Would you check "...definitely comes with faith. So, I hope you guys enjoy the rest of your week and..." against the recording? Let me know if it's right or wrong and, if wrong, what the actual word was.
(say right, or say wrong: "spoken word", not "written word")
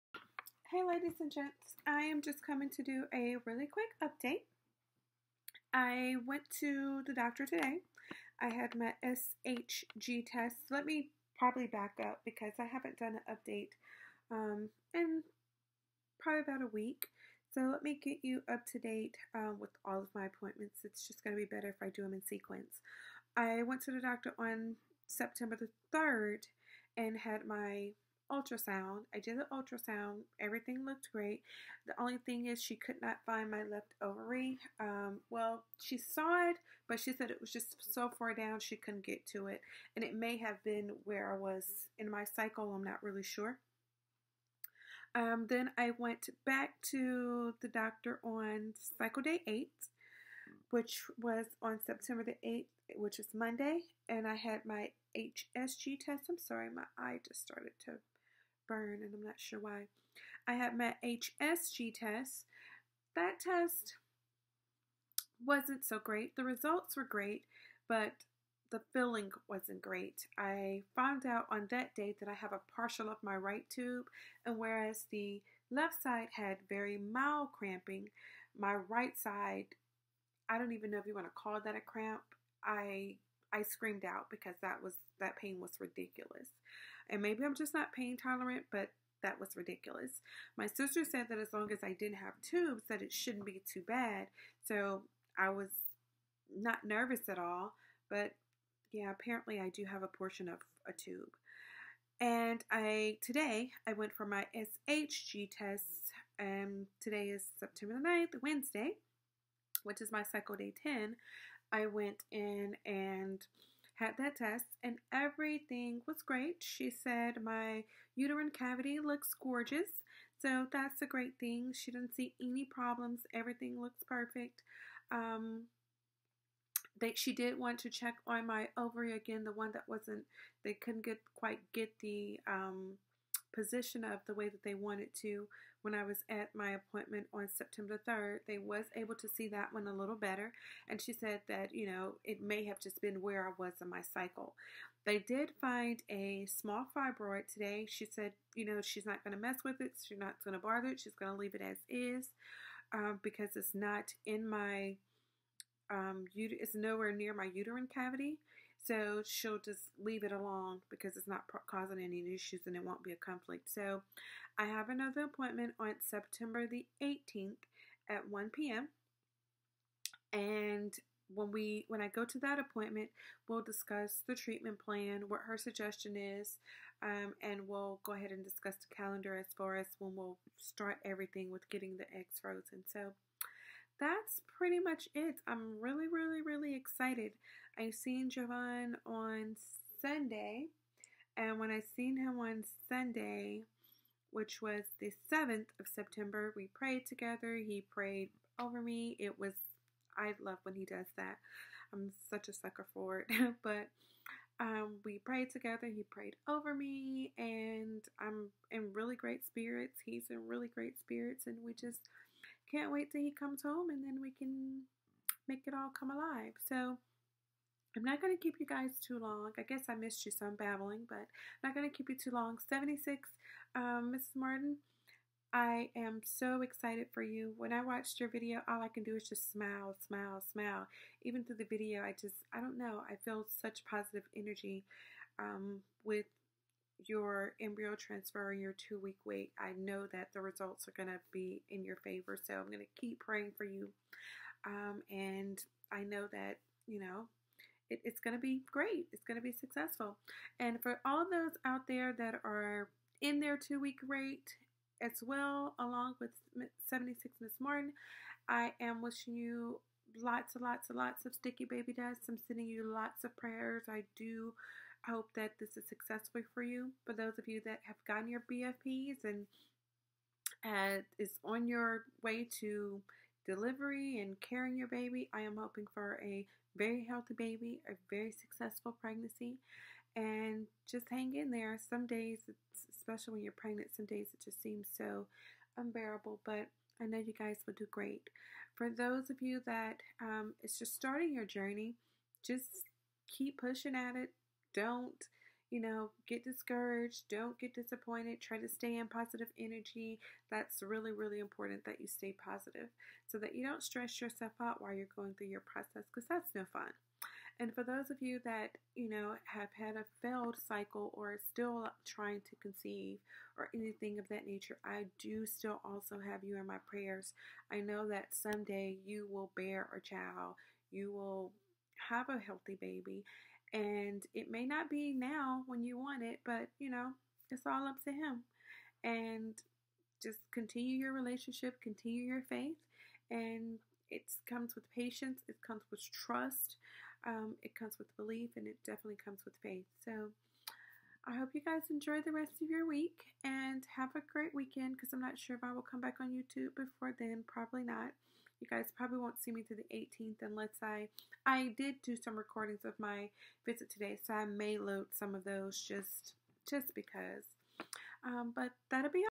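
right.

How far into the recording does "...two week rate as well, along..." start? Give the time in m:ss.
4:13.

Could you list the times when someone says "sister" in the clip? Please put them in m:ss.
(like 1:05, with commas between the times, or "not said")
1:30.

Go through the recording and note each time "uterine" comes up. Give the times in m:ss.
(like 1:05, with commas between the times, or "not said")
1:58, 2:37.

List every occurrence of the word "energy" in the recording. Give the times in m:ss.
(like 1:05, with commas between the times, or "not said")
3:54, 4:59.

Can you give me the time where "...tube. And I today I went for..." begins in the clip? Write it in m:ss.
1:40.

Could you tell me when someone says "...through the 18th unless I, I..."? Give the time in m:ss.
5:49.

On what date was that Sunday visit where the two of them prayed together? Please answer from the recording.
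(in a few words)
September 7.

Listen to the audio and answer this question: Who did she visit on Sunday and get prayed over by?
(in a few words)
Javon.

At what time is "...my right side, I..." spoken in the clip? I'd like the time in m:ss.
1:18.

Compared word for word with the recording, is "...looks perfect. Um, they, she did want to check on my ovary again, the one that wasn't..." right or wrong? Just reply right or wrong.
right.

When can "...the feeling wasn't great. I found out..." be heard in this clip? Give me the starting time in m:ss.
1:08.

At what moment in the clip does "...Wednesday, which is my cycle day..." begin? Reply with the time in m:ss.
1:48.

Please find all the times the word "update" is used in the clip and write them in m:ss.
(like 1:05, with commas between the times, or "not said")
0:04, 0:13.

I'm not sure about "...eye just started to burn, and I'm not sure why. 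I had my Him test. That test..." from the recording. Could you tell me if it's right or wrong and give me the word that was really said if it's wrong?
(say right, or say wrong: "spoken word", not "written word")
wrong: "HSG", not "Him".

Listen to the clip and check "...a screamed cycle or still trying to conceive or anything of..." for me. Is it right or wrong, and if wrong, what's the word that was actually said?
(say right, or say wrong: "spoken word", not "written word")
wrong: "failed", not "screamed".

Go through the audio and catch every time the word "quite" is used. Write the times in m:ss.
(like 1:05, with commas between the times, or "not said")
2:11.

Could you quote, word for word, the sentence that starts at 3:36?
So I'm not going to keep you guys too long.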